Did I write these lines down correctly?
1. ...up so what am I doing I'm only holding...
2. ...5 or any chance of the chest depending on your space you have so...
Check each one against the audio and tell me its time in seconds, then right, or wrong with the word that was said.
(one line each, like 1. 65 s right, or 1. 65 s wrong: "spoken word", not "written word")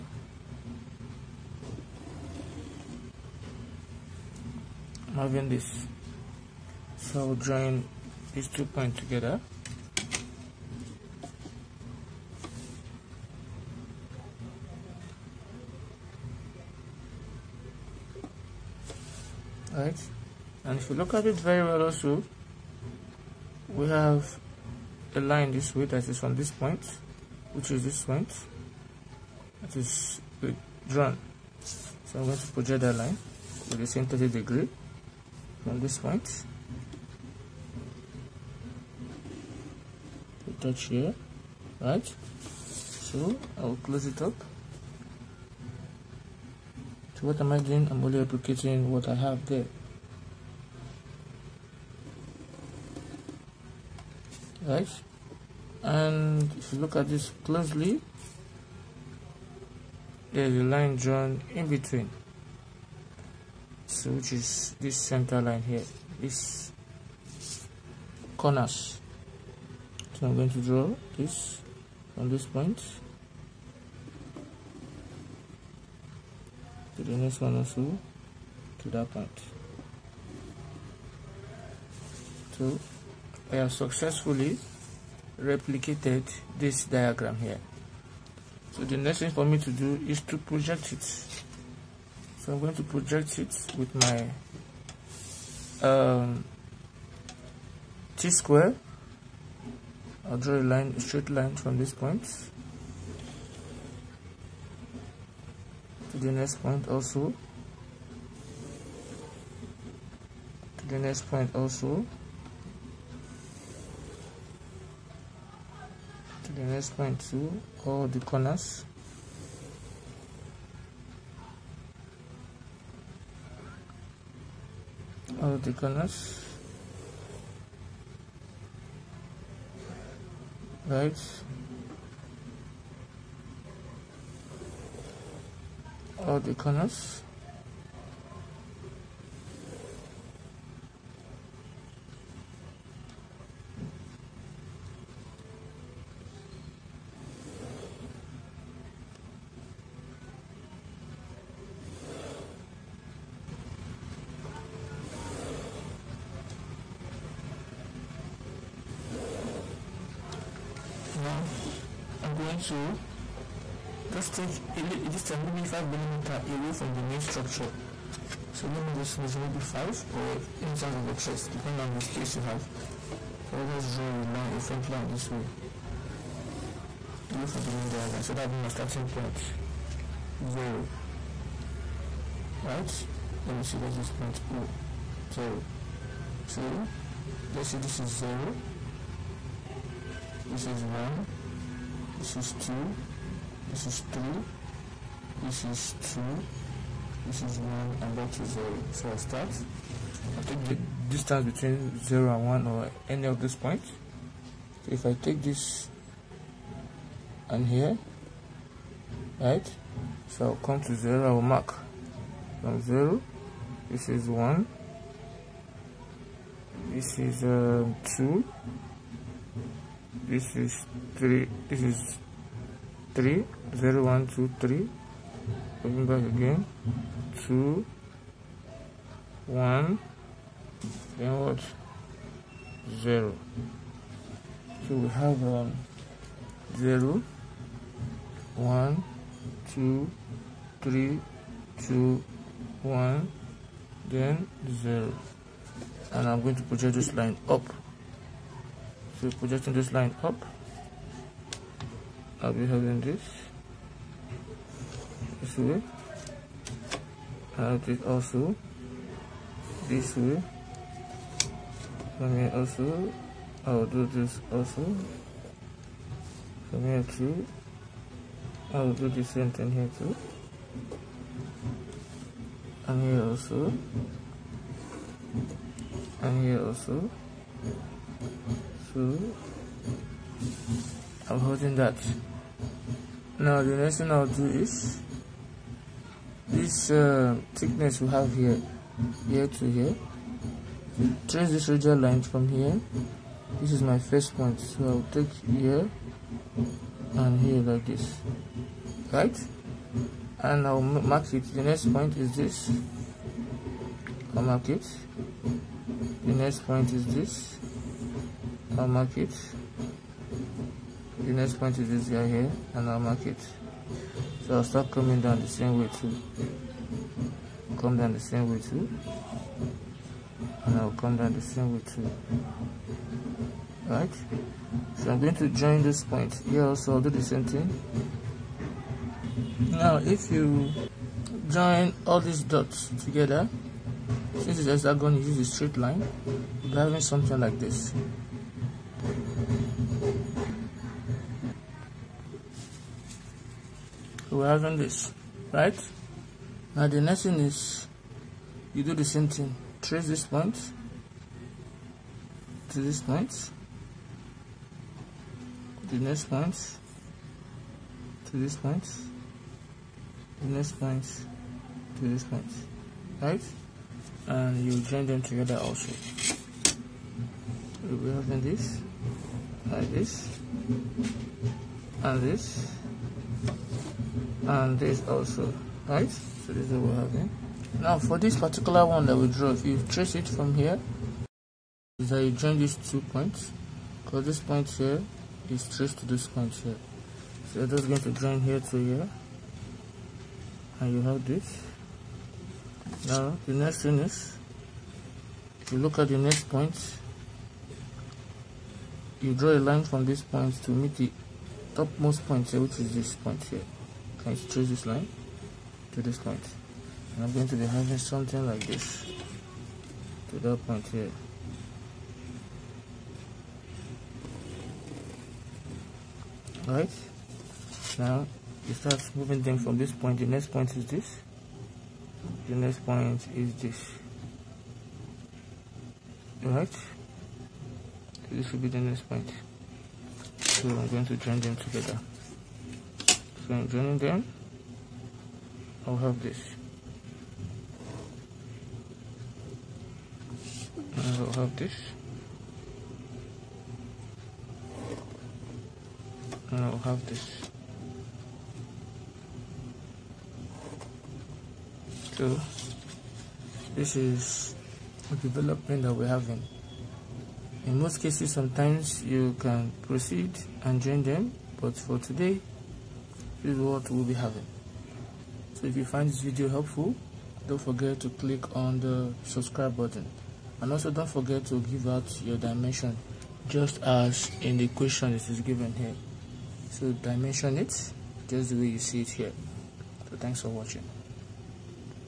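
1. 44 s wrong: "replicating", not "holding"
2. 169 s right.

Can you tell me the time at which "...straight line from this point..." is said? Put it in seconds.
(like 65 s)
101 s.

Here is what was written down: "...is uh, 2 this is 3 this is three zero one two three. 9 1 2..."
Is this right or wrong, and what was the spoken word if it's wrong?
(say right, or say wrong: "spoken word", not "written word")
wrong: "0", not "9".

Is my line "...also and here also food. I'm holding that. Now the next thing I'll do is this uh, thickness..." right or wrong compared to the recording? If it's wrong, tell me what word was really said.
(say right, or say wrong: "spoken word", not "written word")
right.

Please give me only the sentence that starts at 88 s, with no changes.
So the next thing for me to do is to project it.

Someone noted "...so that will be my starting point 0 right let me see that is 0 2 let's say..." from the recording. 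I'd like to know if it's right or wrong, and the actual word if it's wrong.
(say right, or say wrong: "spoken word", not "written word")
right.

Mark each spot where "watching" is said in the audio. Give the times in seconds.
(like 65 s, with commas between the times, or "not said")
480 s.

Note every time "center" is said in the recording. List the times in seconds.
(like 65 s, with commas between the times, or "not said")
64 s.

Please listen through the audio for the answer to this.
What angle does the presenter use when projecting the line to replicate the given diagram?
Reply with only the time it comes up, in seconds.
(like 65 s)
34 s.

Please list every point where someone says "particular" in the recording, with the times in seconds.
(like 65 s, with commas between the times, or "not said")
378 s.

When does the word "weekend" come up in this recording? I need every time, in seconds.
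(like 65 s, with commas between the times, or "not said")
not said.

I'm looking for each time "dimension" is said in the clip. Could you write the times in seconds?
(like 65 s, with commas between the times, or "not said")
472 s, 476 s.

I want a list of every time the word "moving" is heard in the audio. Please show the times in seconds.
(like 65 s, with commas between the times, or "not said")
419 s.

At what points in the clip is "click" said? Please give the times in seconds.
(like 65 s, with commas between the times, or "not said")
468 s.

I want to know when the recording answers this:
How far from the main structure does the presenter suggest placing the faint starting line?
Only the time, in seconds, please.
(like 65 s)
165 s.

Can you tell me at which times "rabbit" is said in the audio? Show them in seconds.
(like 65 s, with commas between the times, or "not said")
not said.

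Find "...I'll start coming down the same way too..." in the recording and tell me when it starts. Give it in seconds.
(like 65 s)
314 s.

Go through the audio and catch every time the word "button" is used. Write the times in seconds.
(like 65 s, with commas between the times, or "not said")
469 s.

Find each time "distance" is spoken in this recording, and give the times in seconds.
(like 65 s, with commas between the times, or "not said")
164 s, 201 s.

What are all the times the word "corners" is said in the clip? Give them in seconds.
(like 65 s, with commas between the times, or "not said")
68 s, 118 s, 125 s, 136 s.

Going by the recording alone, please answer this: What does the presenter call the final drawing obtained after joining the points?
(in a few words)
Development.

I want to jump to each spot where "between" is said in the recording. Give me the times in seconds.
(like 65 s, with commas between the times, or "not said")
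61 s, 201 s.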